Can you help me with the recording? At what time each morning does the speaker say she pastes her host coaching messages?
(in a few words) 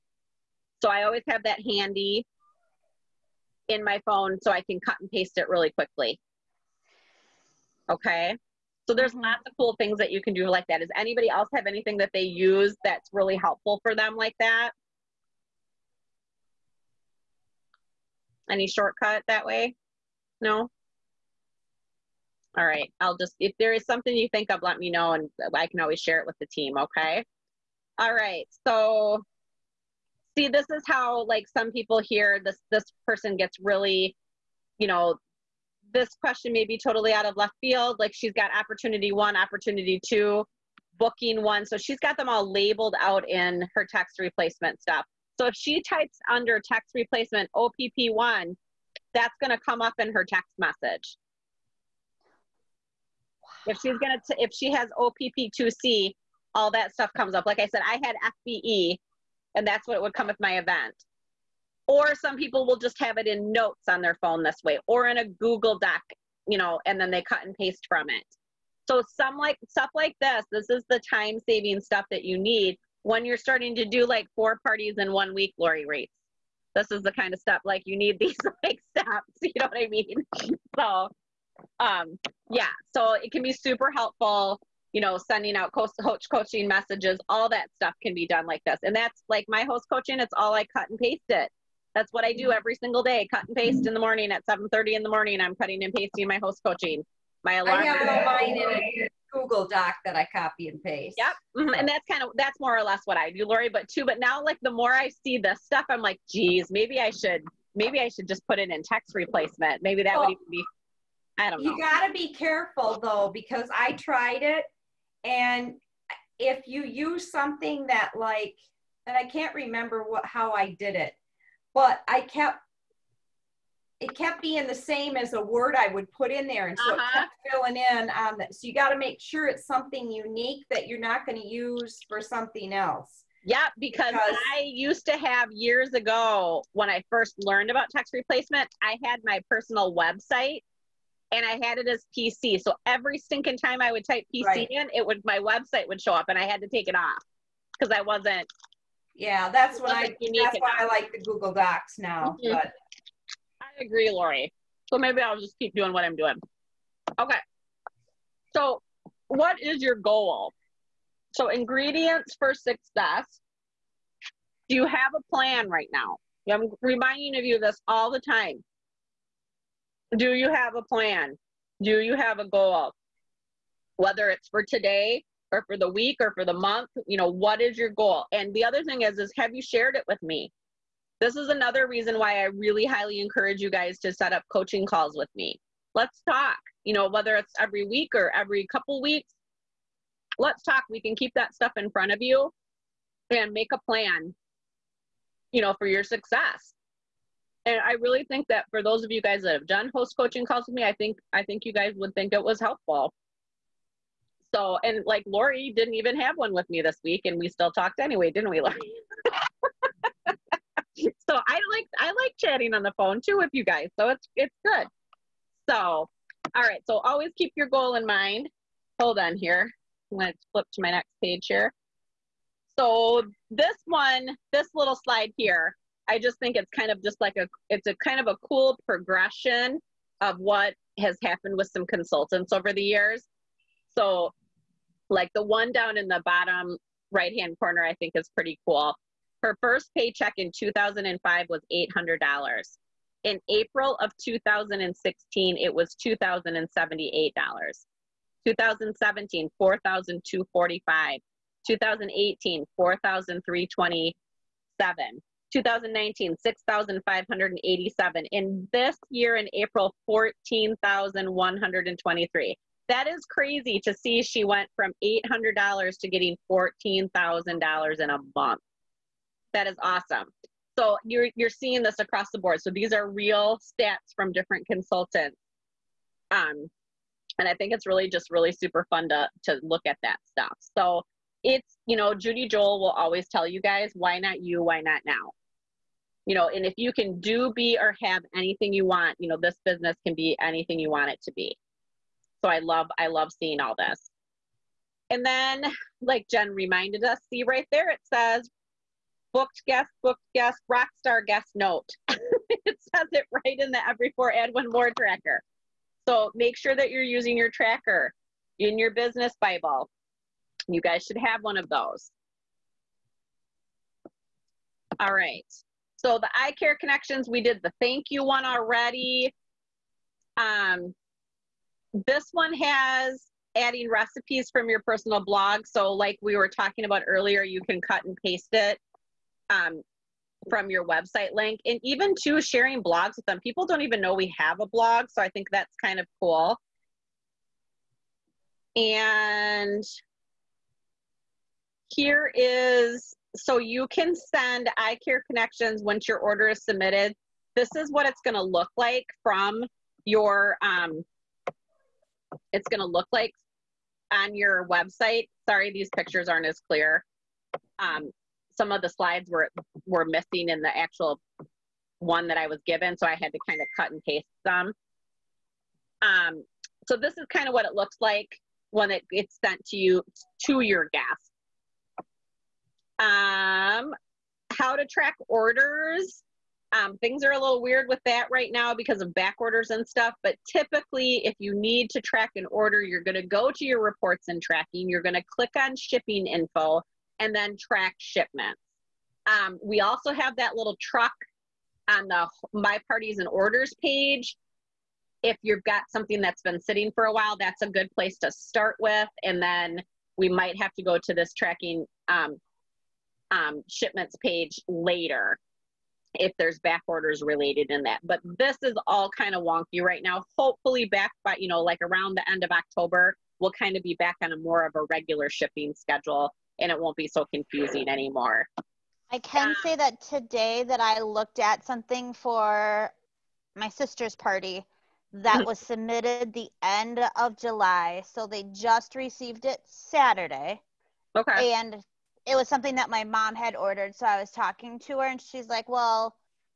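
7:30.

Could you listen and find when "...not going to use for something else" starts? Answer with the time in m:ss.
2:10.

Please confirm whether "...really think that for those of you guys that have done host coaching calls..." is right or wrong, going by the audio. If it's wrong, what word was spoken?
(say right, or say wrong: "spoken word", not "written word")
right.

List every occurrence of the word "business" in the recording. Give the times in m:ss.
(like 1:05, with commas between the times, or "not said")
4:49, 5:08.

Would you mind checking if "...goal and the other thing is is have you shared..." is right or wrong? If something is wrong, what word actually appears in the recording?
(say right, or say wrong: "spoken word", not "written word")
right.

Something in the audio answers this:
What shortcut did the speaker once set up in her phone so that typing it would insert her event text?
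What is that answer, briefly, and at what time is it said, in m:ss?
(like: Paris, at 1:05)
FBE, at 0:58.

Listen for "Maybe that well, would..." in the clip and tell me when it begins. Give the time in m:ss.
1:49.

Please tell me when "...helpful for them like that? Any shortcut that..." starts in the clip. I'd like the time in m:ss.
0:13.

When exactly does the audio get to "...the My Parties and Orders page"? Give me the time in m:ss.
6:32.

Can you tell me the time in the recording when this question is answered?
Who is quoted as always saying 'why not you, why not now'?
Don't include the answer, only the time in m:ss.
4:42.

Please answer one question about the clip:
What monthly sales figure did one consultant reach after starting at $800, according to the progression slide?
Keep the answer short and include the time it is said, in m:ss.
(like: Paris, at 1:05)
$14,000, at 4:26.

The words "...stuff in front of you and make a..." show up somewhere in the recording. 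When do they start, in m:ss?
3:11.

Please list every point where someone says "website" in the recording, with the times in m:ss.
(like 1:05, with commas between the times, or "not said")
2:19, 2:25, 5:30, 5:54.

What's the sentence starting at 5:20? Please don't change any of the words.
Um, this one has adding recipes from your personal blog.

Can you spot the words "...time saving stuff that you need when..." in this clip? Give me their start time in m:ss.
1:11.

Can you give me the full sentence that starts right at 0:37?
Like she's got opportunity one, opportunity two, booking one.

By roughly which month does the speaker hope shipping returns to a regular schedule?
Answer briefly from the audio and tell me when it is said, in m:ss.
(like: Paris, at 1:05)
October, at 6:52.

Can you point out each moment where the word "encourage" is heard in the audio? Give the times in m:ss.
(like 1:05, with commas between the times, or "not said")
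3:03.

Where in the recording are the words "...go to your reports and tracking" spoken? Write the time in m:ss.
6:23.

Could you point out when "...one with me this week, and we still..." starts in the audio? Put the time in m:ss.
3:26.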